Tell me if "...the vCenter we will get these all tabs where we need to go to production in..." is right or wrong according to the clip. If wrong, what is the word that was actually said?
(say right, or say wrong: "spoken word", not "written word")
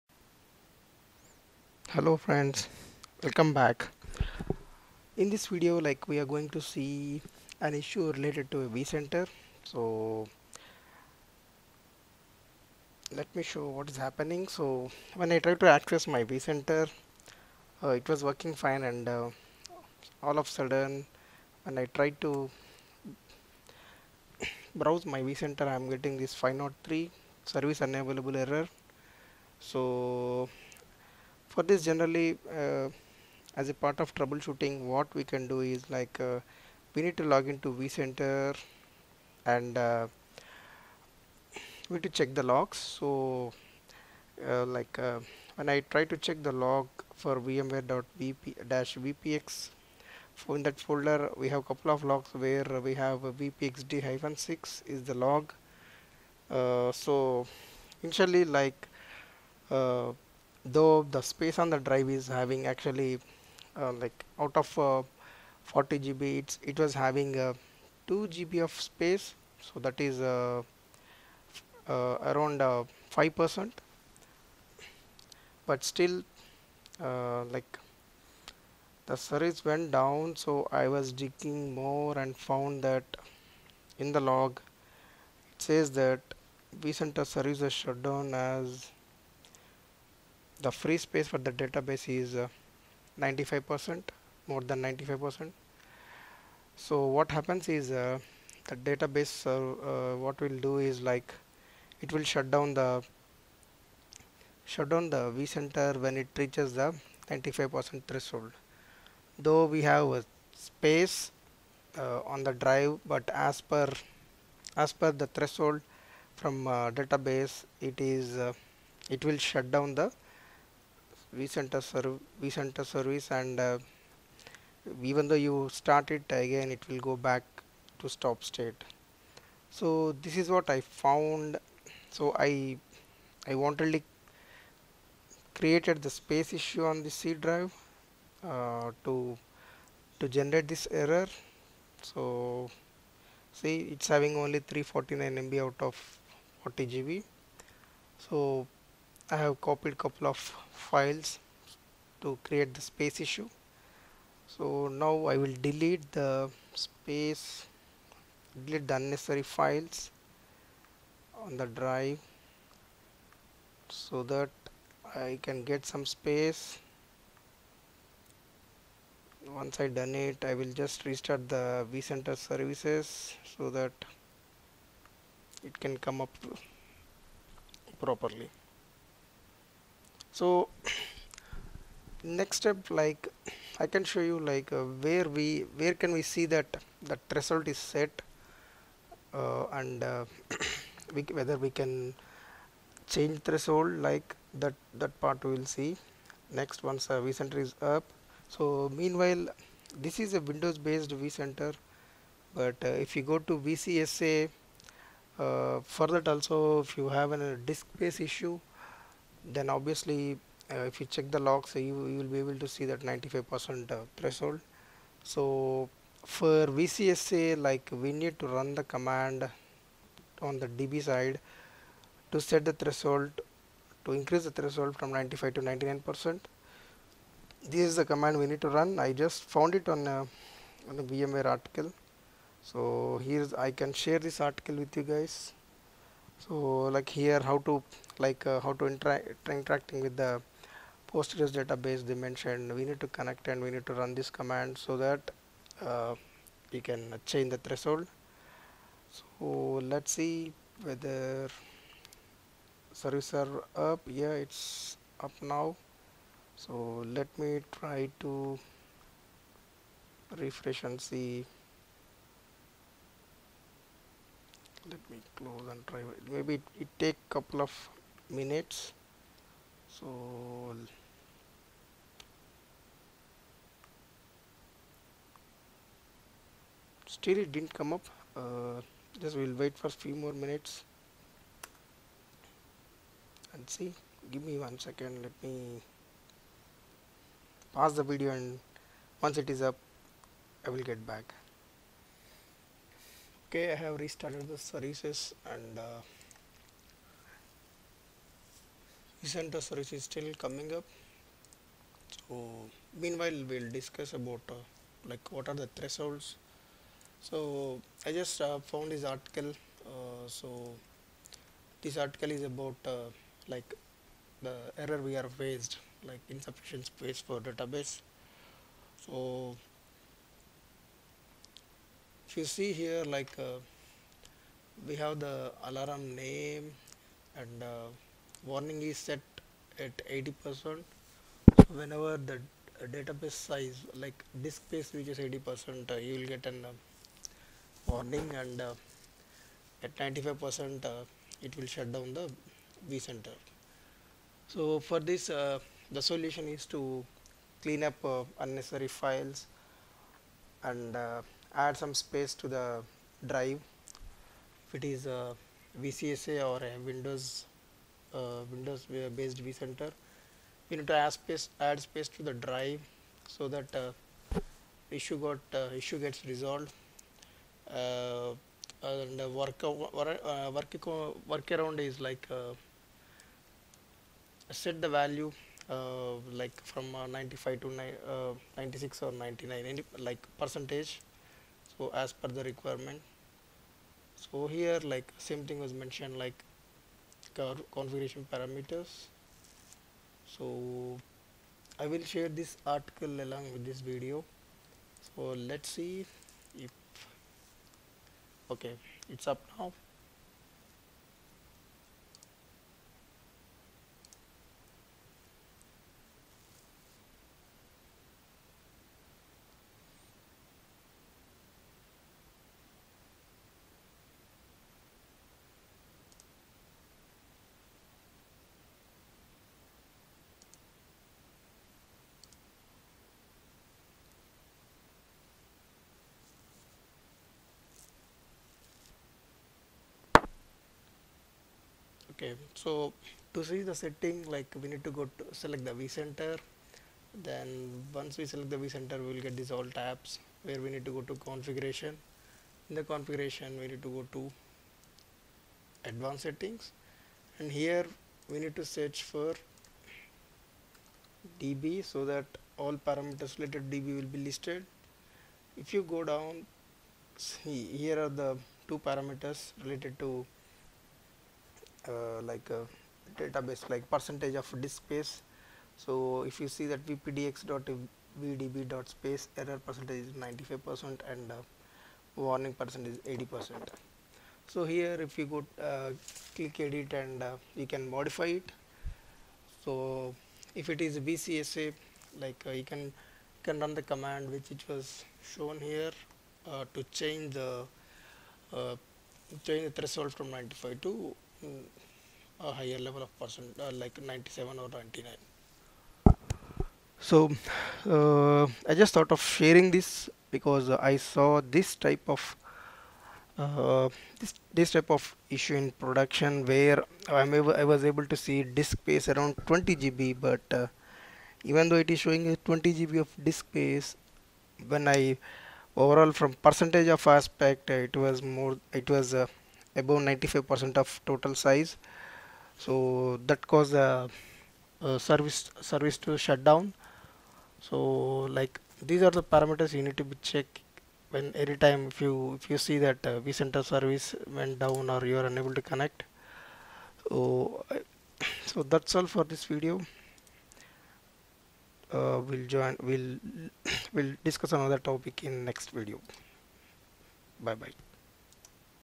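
wrong: "configuration", not "production".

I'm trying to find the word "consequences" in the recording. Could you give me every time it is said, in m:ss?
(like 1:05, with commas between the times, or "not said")
not said.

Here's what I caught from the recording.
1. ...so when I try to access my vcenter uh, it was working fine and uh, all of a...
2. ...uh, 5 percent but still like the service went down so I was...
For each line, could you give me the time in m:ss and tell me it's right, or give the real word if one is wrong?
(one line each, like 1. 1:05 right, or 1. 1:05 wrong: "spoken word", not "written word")
1. 0:14 right
2. 1:12 right.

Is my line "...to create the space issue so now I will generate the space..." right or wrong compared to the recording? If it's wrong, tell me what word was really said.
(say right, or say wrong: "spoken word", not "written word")
wrong: "delete", not "generate".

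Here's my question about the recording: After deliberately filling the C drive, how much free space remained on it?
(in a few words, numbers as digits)
349 MB.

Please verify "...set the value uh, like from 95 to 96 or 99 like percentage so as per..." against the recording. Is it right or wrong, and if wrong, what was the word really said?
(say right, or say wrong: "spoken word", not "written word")
right.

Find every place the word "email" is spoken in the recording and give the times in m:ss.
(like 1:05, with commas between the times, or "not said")
not said.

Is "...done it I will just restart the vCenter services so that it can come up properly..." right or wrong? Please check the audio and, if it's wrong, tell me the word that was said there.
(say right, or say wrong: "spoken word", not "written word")
right.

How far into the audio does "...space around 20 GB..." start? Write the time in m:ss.
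8:28.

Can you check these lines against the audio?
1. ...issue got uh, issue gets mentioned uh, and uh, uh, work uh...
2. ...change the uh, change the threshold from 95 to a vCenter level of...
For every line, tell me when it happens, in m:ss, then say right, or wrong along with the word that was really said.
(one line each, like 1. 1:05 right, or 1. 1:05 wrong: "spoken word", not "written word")
1. 6:04 wrong: "resolved", not "mentioned"
2. 8:06 wrong: "higher", not "vCenter".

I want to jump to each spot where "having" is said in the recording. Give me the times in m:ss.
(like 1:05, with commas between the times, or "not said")
1:02, 1:06, 2:24.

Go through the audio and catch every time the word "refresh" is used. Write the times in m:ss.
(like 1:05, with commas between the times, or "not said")
4:20.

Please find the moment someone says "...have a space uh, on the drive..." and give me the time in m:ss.
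1:49.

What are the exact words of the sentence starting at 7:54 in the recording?
So, here if you go uh, click edit and you can modify it.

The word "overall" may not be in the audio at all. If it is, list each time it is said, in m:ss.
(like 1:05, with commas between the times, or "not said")
8:35.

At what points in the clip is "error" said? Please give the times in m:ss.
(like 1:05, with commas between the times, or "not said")
0:28, 2:20, 5:14, 7:49.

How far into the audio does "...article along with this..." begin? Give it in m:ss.
6:32.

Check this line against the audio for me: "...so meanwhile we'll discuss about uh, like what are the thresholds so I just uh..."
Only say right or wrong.
right.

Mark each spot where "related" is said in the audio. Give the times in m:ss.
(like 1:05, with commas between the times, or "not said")
0:08, 7:33, 7:39.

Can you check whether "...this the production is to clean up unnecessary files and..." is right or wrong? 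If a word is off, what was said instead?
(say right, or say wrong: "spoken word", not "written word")
wrong: "solution", not "production".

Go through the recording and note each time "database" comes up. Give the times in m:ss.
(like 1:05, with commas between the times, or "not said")
1:31, 1:38, 1:56, 4:01, 5:17, 5:32, 7:43.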